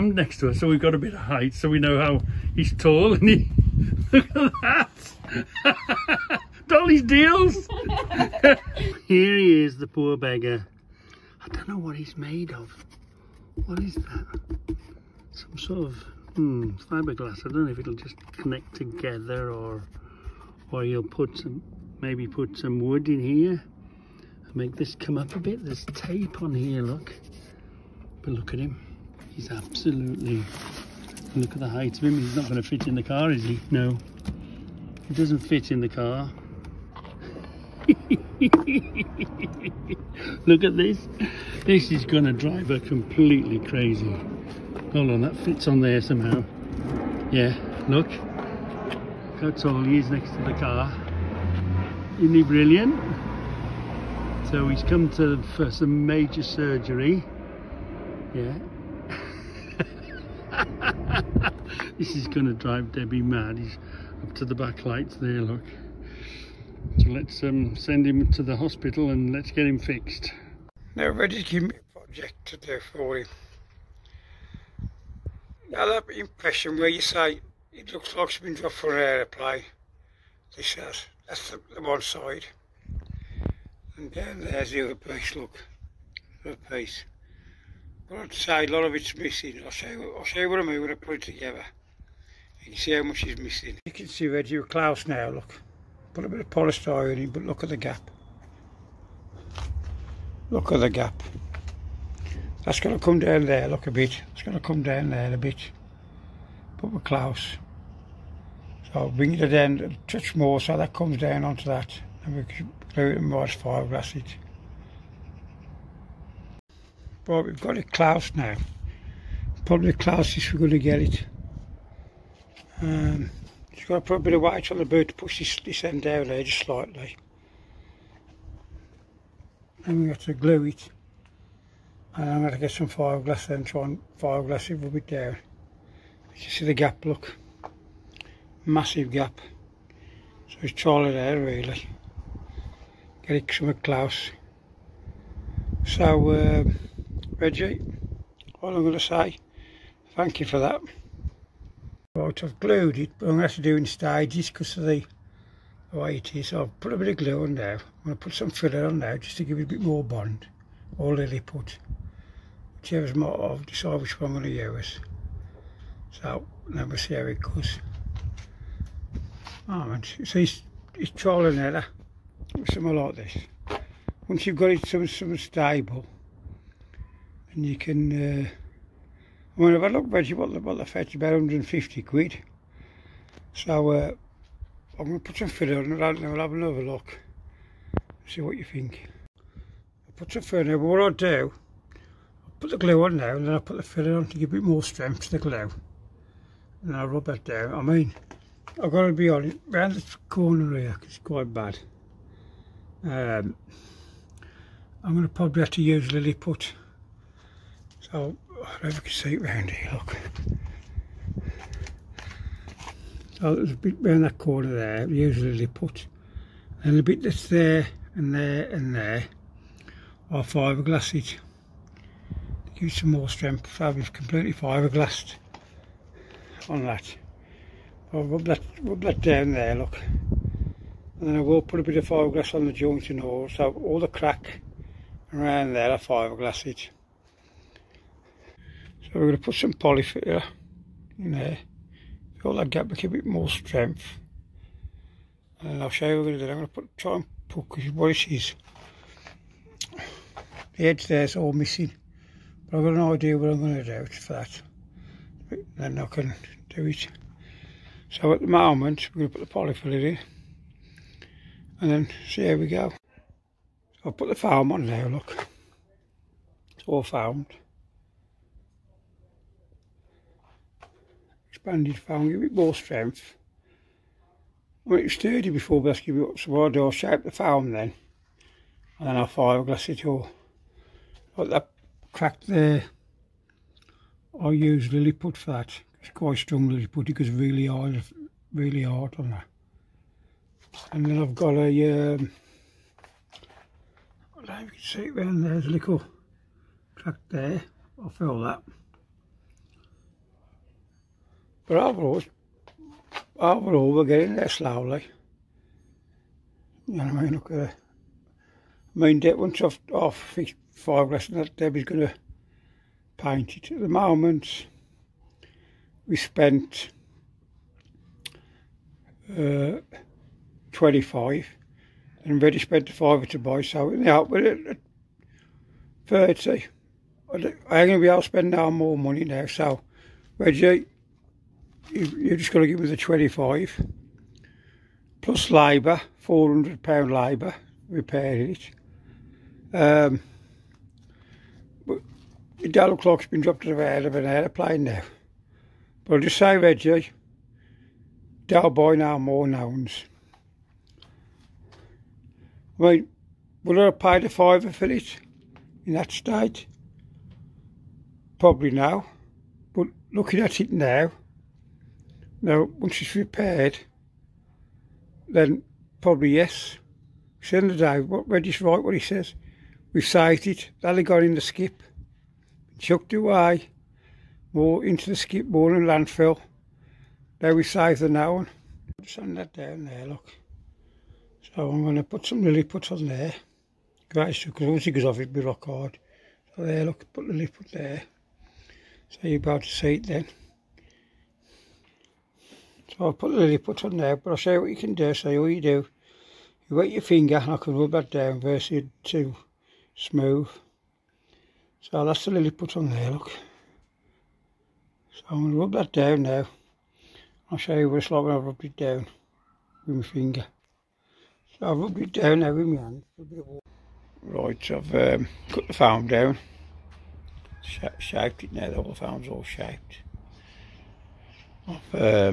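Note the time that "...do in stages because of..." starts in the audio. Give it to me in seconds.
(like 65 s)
153 s.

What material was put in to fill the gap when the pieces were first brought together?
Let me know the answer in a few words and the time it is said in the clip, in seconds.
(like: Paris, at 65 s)
polystyrene, at 96 s.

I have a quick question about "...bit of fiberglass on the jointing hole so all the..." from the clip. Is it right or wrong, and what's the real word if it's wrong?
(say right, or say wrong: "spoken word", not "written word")
right.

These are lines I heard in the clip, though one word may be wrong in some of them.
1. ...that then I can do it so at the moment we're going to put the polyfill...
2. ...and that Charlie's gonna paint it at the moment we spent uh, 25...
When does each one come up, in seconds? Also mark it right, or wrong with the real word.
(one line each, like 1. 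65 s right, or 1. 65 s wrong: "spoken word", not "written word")
1. 254 s right
2. 311 s wrong: "Debbie", not "Charlie".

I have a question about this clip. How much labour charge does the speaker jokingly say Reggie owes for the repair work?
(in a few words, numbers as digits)
£400.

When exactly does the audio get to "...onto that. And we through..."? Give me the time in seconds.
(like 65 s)
111 s.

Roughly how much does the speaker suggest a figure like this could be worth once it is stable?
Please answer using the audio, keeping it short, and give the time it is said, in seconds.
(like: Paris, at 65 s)
£150, at 181 s.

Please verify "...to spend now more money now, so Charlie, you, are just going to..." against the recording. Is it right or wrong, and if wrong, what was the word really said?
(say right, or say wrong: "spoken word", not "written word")
wrong: "Reggie", not "Charlie".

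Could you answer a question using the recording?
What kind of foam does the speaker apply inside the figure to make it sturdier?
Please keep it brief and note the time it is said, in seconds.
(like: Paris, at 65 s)
expanded foam, at 271 s.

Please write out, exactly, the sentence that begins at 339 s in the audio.
Um, but the dial clock's been dropped to about of an aeroplane now.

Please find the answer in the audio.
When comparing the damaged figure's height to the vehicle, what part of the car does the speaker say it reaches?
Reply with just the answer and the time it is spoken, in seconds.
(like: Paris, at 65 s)
the back lights, at 64 s.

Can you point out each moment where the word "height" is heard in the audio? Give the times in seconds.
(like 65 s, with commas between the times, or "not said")
1 s, 31 s.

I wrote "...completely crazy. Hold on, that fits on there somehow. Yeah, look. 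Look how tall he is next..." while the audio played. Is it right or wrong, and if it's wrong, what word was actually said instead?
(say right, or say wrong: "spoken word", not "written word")
right.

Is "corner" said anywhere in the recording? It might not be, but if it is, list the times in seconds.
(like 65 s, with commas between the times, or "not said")
200 s, 214 s.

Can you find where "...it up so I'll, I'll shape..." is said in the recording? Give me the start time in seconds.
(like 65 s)
276 s.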